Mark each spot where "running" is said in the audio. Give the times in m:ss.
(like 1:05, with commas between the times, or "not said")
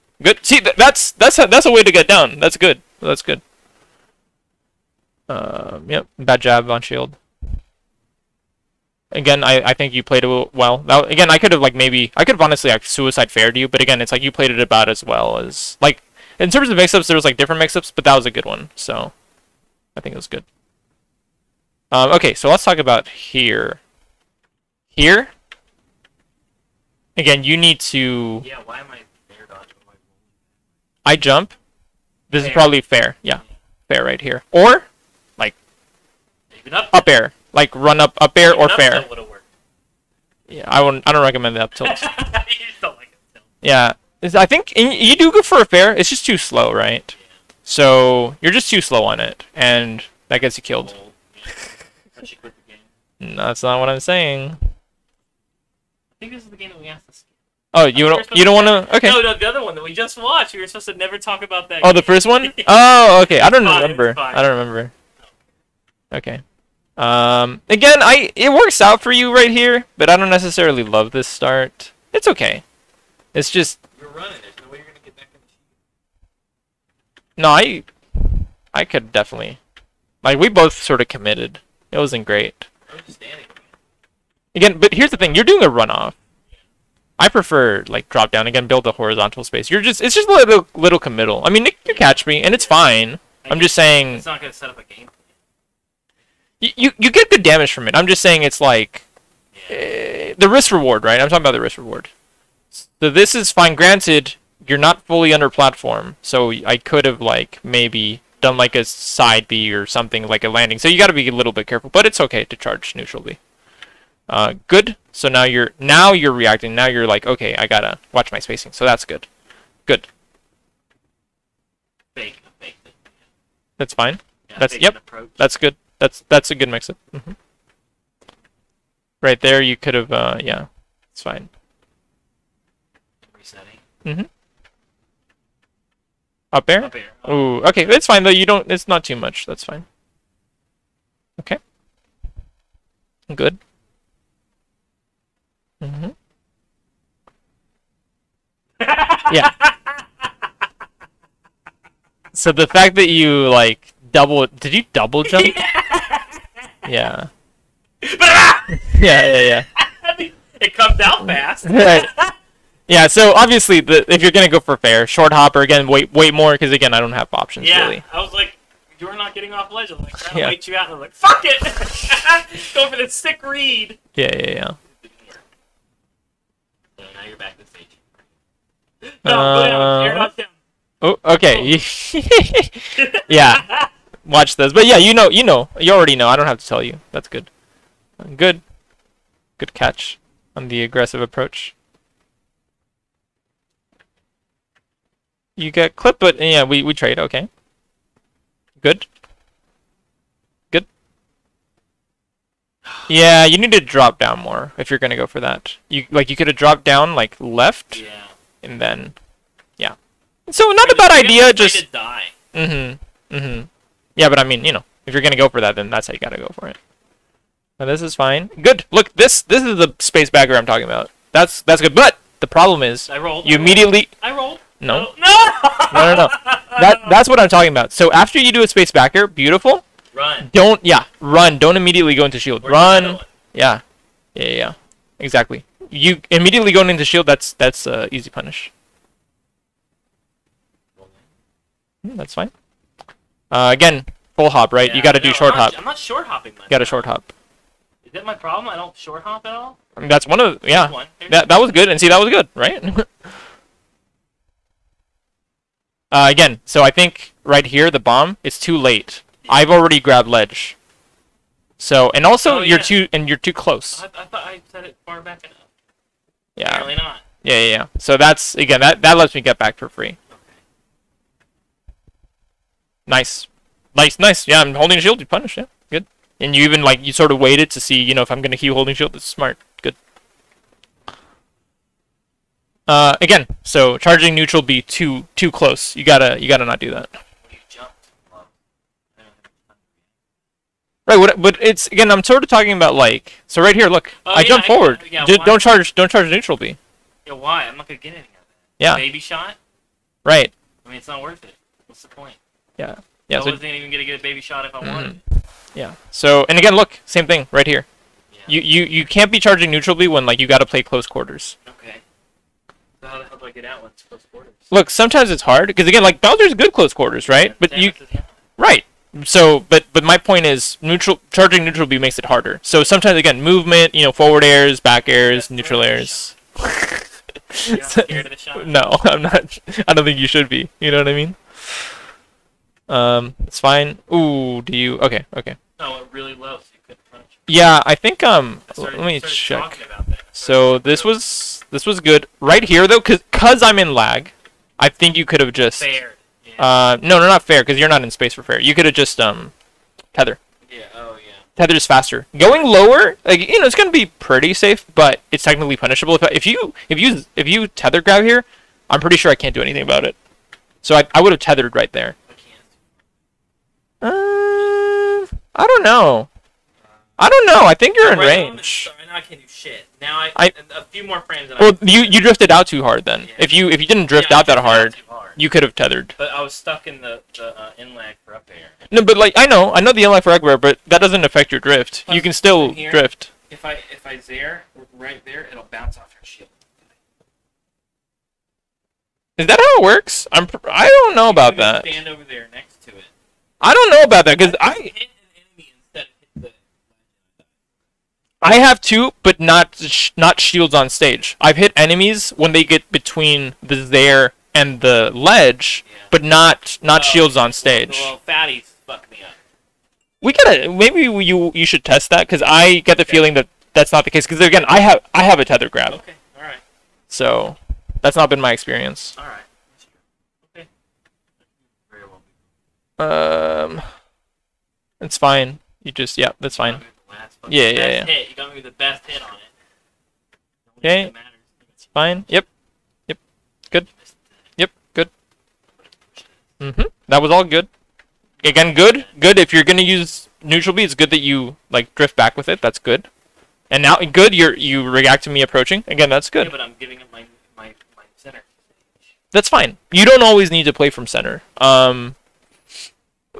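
1:14.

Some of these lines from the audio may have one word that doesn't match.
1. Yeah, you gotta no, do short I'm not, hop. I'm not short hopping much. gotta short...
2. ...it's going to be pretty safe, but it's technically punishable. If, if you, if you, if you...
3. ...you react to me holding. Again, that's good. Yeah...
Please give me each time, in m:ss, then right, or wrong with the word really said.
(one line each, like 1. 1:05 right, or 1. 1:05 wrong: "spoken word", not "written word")
1. 4:04 right
2. 5:53 right
3. 7:24 wrong: "approaching", not "holding".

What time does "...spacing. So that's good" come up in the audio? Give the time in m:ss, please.
1:58.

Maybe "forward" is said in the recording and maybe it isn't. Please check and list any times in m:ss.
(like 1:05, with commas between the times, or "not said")
4:54, 5:24.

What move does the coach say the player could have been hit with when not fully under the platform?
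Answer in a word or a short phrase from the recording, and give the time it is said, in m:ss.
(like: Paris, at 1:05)
side B, at 1:48.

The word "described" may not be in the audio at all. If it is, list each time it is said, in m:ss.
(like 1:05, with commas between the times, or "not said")
not said.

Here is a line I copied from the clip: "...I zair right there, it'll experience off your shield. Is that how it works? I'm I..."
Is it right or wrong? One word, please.
wrong.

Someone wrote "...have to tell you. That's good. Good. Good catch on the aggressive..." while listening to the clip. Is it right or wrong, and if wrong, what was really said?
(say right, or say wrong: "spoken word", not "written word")
right.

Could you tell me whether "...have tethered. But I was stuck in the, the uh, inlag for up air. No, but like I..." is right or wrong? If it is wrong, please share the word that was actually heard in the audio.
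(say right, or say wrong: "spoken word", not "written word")
right.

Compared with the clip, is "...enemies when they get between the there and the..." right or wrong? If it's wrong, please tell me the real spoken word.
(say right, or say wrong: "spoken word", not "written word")
right.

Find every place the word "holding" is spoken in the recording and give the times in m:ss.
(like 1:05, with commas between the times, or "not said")
4:34, 4:38.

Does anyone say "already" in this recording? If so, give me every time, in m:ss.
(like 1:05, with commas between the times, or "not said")
3:05, 4:19.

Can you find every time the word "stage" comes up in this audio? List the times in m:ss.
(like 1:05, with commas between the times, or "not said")
2:57, 6:40, 6:47.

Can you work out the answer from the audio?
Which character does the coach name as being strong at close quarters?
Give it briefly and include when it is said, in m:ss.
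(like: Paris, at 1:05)
Bowser, at 5:16.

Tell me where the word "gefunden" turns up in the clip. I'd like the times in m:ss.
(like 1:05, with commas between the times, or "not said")
not said.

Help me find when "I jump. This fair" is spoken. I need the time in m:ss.
0:31.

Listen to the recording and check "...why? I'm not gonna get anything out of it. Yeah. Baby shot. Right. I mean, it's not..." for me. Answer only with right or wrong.
right.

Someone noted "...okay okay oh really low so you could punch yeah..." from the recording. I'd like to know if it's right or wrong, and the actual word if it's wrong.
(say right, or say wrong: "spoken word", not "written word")
right.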